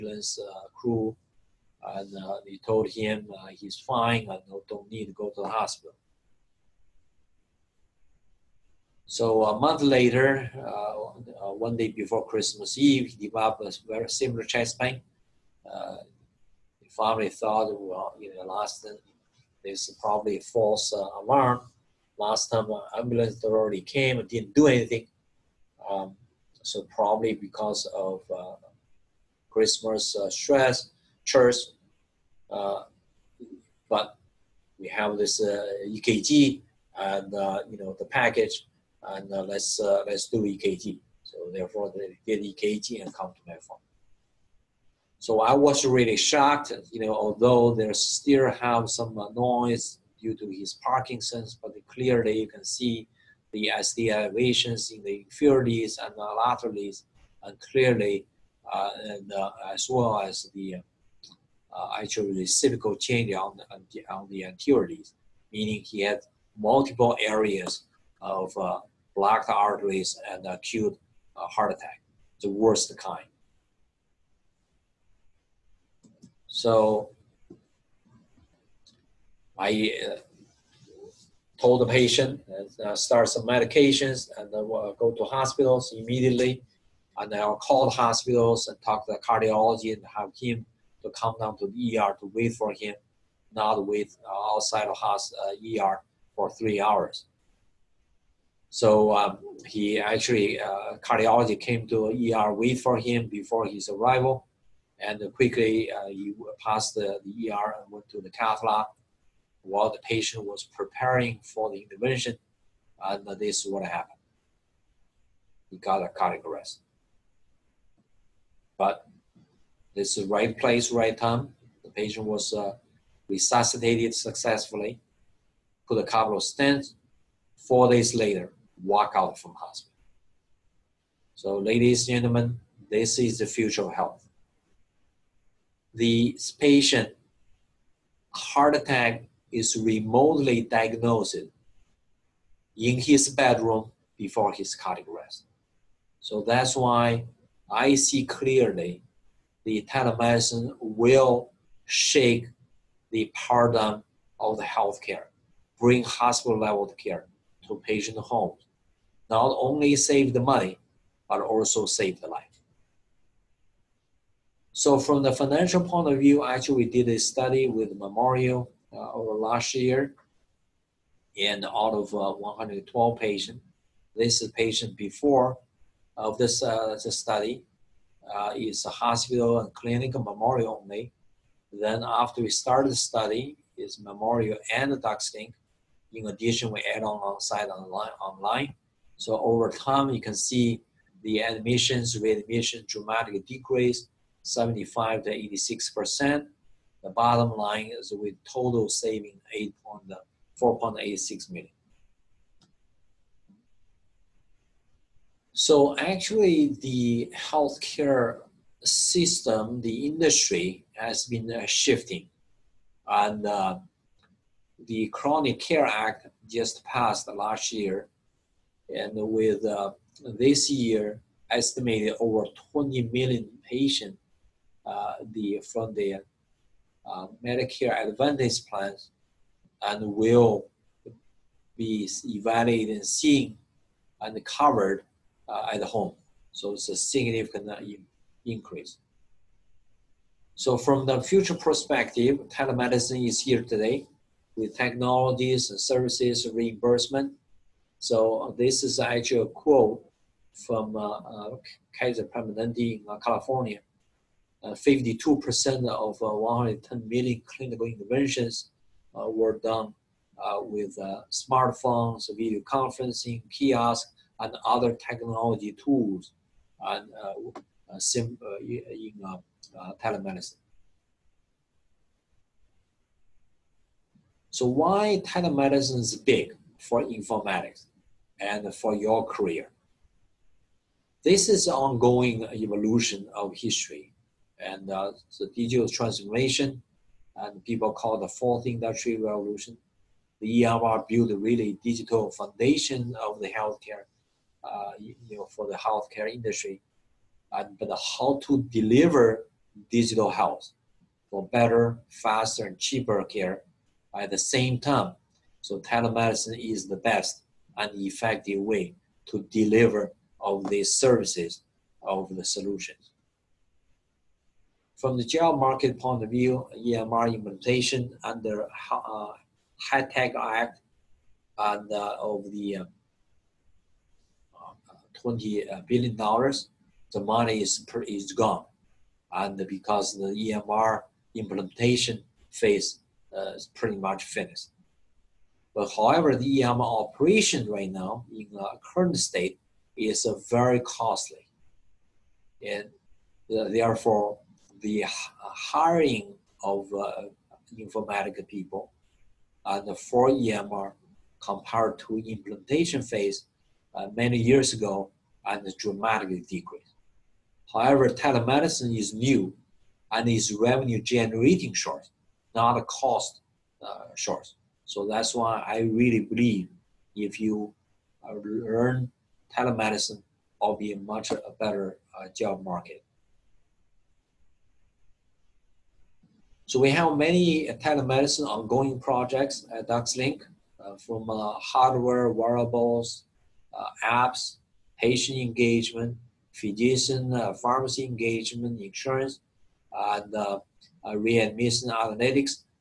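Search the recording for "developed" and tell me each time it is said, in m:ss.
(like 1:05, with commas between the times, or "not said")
0:13.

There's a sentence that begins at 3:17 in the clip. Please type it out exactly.
The bottom line is with total saving point eighty-six million.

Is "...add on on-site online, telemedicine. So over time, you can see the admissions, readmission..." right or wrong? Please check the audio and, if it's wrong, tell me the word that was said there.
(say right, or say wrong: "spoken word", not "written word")
wrong: "online", not "telemedicine".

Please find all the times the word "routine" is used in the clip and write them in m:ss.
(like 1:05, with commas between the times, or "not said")
not said.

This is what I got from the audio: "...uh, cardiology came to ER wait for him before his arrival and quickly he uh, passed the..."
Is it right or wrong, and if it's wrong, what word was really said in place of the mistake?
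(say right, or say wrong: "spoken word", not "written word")
right.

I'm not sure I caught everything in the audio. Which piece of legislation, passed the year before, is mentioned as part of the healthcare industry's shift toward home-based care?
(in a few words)
Chronic Care Act.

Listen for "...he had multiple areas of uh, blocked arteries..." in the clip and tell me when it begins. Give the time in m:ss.
1:05.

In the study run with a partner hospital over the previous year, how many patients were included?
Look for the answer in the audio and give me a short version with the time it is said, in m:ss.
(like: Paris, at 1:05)
112, at 2:52.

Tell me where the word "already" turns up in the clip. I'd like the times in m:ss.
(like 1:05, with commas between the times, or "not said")
0:23.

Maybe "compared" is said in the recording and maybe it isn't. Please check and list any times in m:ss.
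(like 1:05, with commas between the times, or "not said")
5:51.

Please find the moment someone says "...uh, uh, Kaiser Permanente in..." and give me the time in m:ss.
4:10.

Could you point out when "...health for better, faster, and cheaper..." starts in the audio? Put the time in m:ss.
5:00.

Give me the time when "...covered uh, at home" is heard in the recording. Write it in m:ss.
3:54.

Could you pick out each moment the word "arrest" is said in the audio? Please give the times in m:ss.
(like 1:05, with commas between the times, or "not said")
1:56, 2:25.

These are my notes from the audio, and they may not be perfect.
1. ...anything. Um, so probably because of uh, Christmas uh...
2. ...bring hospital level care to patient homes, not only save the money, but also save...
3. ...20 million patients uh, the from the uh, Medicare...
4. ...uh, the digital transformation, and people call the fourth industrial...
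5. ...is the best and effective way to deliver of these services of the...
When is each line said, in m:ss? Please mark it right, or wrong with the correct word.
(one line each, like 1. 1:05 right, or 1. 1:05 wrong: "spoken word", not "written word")
1. 0:24 right
2. 2:35 right
3. 3:42 right
4. 4:44 right
5. 5:06 right.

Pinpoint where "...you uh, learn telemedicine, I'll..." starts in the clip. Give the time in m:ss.
6:07.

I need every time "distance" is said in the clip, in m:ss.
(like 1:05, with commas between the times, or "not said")
not said.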